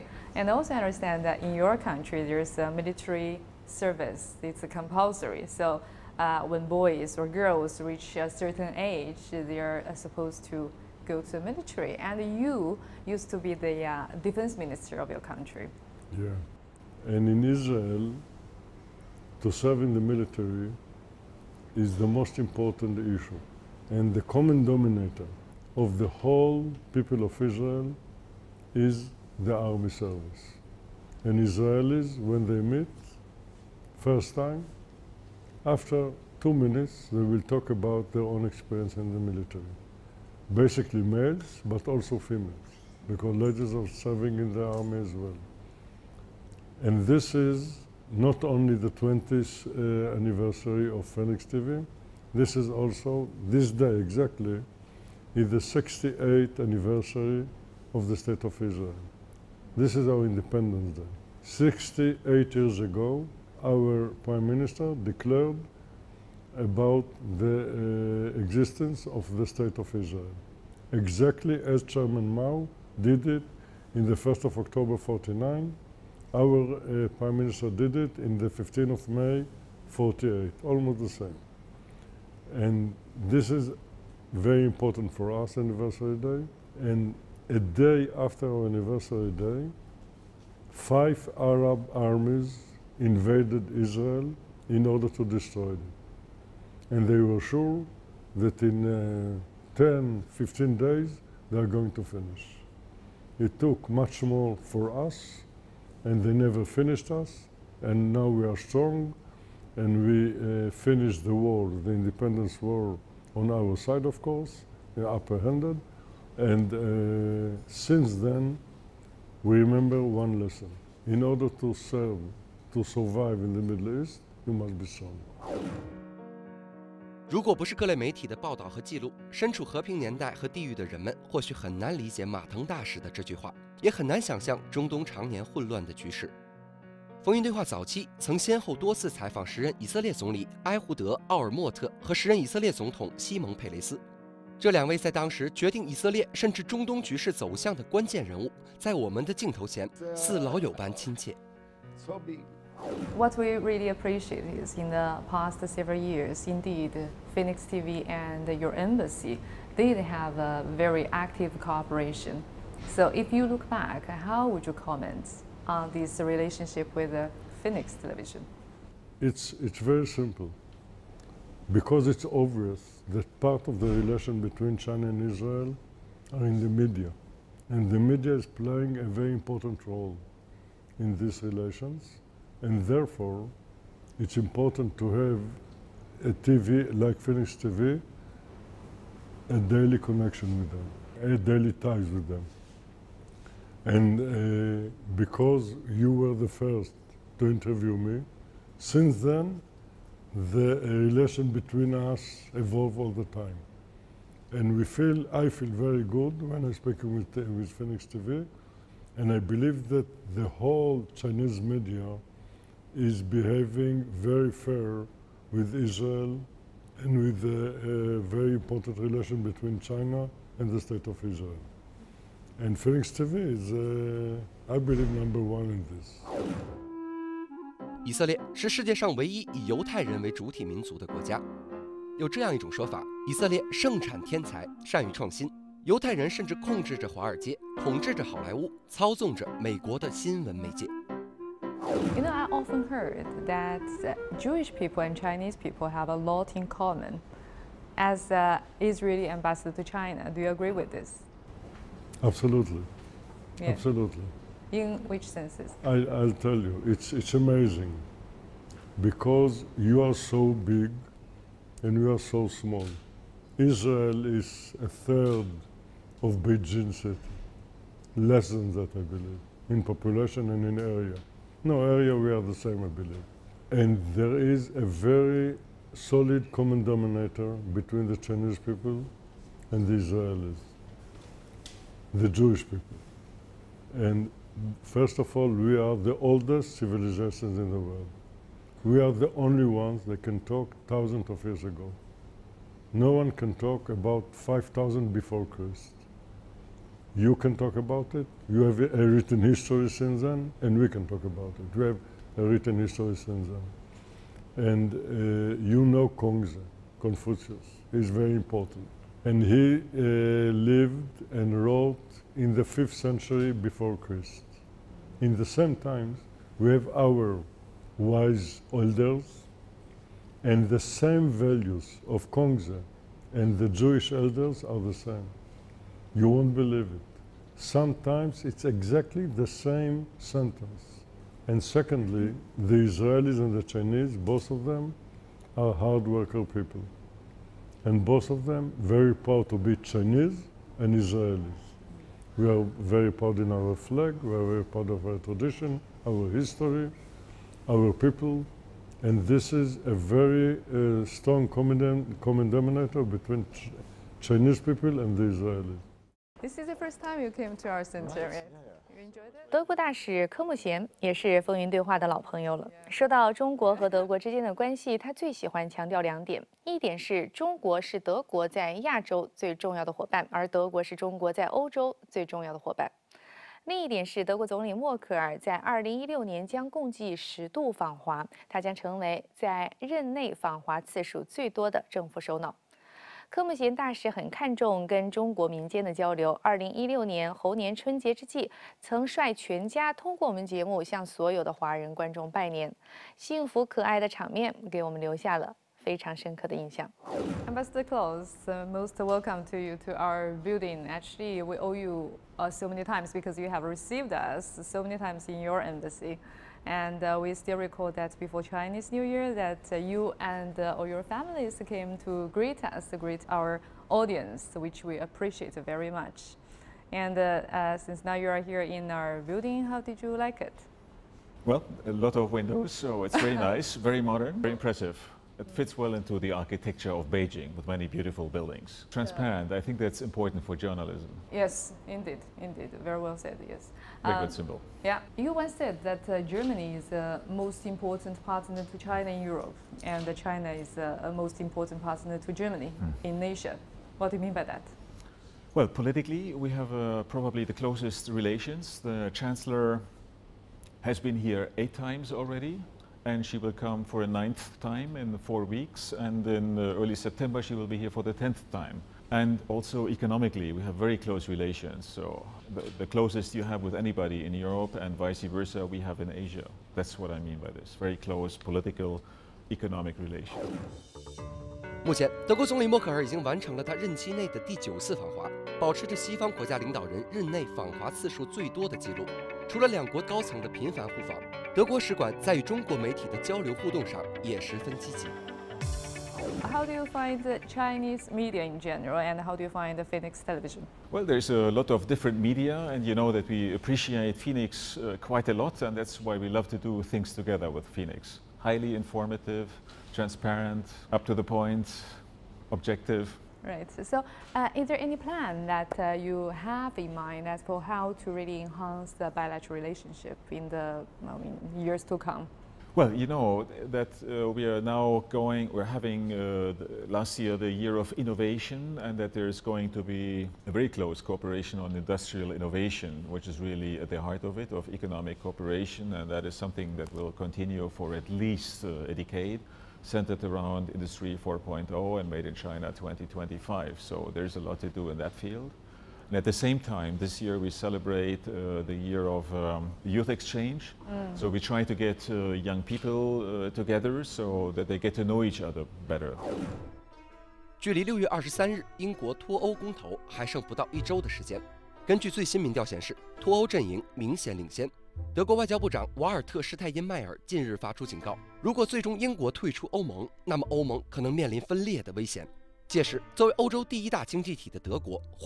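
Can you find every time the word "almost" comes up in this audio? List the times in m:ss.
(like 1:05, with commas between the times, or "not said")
1:20.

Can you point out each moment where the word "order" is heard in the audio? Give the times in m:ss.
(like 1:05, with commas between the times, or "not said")
1:34, 2:01.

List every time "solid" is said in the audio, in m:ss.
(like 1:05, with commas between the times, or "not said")
4:35.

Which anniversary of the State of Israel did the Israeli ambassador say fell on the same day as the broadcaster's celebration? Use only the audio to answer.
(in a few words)
68th.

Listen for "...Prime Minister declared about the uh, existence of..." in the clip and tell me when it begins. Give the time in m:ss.
1:04.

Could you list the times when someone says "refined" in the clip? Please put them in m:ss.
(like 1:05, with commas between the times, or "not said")
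not said.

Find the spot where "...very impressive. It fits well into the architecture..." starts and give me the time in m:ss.
7:04.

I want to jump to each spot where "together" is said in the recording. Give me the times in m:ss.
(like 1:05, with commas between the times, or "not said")
8:17, 9:03.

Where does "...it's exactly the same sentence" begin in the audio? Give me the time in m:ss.
5:28.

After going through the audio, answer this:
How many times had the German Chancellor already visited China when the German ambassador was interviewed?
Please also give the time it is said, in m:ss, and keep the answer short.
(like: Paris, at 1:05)
8, at 7:31.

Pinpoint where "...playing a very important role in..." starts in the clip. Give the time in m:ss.
2:58.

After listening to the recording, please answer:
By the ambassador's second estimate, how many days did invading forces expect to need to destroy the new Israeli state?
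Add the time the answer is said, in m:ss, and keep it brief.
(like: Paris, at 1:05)
15, at 1:40.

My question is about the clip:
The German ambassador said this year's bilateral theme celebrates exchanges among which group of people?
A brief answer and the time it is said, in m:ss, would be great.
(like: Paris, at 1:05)
youth, at 8:59.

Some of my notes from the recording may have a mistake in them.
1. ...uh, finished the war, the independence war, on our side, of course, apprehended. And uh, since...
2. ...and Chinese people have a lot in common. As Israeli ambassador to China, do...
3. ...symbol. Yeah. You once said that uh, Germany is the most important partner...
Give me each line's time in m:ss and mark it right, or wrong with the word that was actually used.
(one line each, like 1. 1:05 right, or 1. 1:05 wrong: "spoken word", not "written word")
1. 1:50 right
2. 4:05 right
3. 7:14 right.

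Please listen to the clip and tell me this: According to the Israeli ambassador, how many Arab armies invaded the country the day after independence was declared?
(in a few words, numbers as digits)
5.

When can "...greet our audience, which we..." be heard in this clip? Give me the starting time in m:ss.
6:52.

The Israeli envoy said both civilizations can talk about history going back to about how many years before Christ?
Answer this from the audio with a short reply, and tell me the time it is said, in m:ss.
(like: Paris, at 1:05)
5,000, at 4:54.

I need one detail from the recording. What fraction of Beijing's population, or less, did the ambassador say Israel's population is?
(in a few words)
a third.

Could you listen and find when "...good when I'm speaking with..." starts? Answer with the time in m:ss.
3:26.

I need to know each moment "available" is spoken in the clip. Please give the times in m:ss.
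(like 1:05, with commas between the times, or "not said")
not said.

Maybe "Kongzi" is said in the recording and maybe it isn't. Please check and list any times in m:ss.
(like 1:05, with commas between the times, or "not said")
5:06, 5:22.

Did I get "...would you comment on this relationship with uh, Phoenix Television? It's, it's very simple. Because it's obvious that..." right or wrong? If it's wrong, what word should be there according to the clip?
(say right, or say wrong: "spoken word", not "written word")
right.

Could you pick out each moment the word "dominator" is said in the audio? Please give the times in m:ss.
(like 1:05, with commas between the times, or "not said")
0:24.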